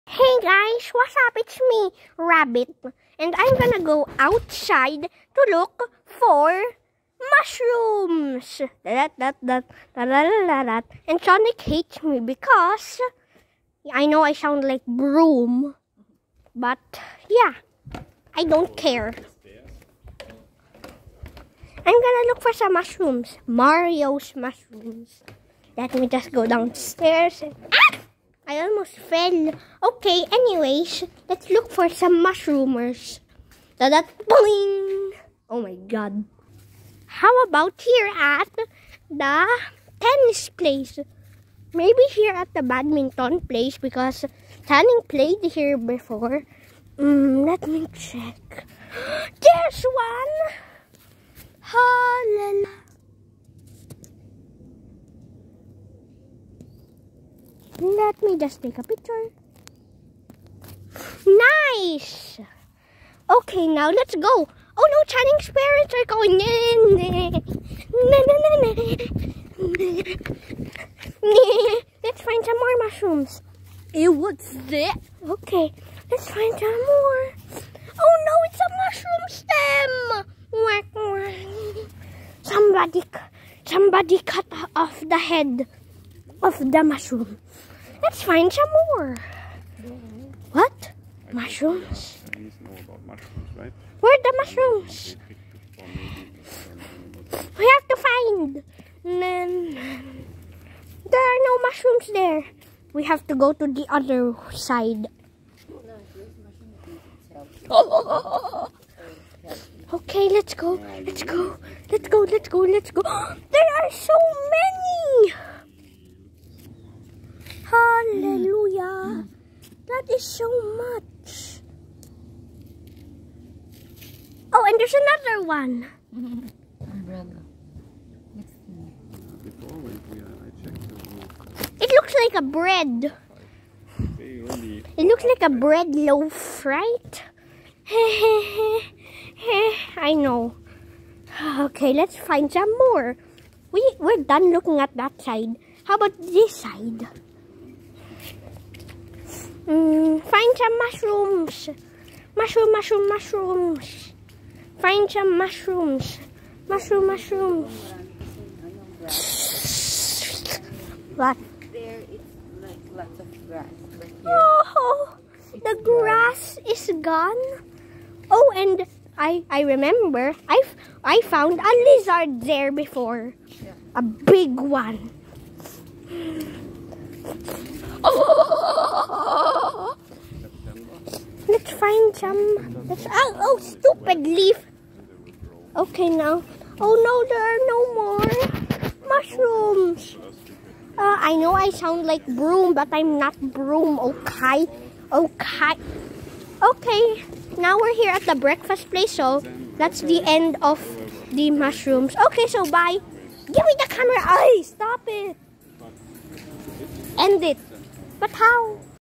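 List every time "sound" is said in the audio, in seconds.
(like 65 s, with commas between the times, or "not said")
14 s, 191 s.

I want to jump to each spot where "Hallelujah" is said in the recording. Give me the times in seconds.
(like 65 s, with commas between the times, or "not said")
51 s, 117 s.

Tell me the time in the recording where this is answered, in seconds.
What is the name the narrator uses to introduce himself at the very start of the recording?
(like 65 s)
2 s.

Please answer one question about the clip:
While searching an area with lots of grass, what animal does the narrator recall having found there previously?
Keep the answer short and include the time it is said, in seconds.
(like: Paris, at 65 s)
A lizard, at 171 s.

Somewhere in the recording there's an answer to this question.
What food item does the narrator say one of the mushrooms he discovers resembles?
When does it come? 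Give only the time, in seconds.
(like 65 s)
135 s.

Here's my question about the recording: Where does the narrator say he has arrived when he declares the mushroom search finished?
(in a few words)
The breakfast place.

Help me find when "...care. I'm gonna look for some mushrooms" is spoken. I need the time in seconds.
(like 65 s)
18 s.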